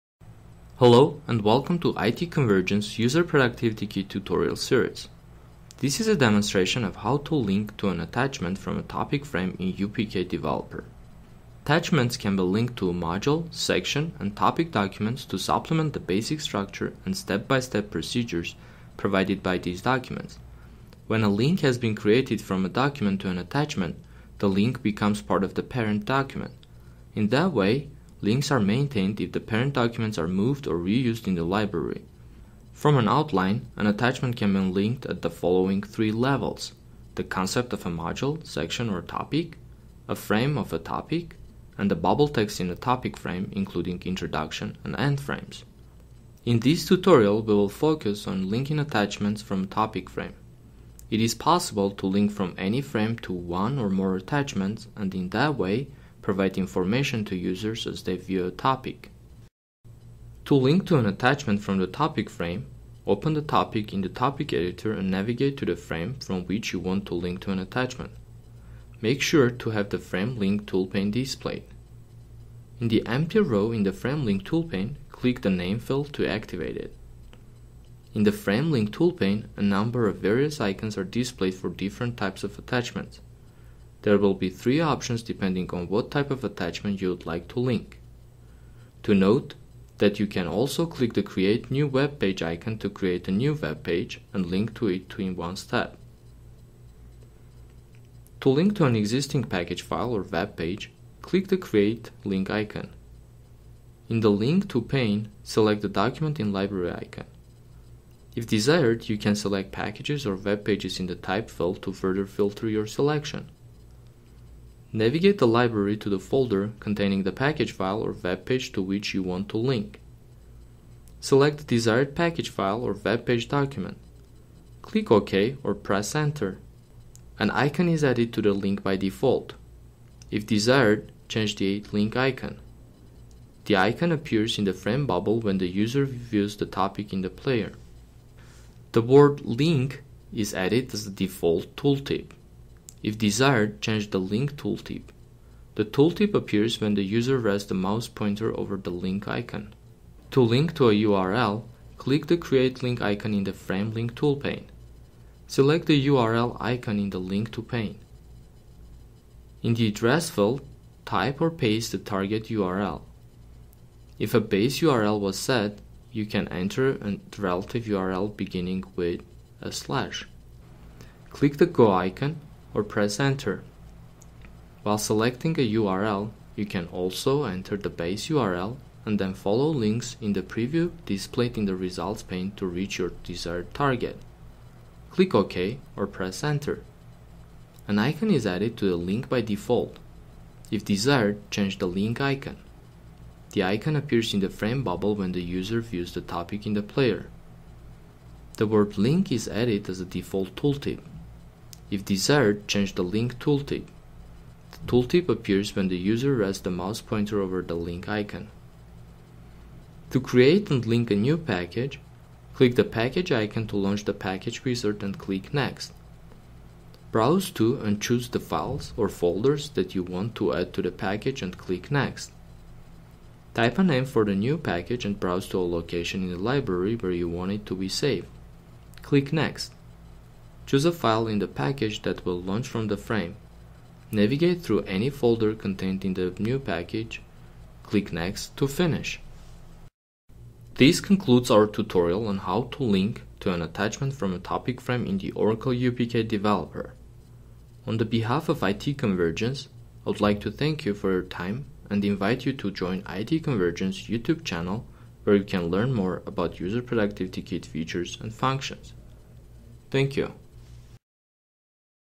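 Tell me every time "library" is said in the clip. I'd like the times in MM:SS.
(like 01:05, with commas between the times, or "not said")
00:31, 01:46, 01:55, 03:46.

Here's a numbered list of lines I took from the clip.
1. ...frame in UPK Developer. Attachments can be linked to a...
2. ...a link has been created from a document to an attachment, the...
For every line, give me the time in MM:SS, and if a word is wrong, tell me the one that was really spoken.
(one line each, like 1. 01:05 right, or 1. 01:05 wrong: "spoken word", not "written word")
1. 00:09 right
2. 00:21 right.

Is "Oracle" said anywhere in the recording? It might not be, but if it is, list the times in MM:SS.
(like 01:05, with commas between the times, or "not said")
04:05.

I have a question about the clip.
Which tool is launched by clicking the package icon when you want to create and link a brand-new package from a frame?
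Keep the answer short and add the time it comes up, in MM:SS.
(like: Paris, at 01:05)
package wizard, at 03:34.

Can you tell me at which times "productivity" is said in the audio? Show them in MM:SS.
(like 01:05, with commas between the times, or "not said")
00:03, 04:16.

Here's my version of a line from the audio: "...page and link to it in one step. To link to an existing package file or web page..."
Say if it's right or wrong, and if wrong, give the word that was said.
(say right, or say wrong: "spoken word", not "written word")
right.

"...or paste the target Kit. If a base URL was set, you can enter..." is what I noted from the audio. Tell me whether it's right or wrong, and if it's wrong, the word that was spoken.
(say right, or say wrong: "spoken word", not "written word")
wrong: "URL", not "Kit".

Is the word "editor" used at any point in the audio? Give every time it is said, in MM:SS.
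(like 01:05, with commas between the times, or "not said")
01:04.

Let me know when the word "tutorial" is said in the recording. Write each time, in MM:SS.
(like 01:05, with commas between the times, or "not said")
00:04, 00:46, 04:01.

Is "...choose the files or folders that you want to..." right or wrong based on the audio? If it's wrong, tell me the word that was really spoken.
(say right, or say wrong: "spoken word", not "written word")
right.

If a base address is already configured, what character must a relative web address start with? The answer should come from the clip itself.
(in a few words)
a slash.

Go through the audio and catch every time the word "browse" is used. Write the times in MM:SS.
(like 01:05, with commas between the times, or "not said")
03:37, 03:45.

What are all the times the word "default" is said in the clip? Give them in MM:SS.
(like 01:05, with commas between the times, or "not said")
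02:08, 02:21, 03:09, 03:20.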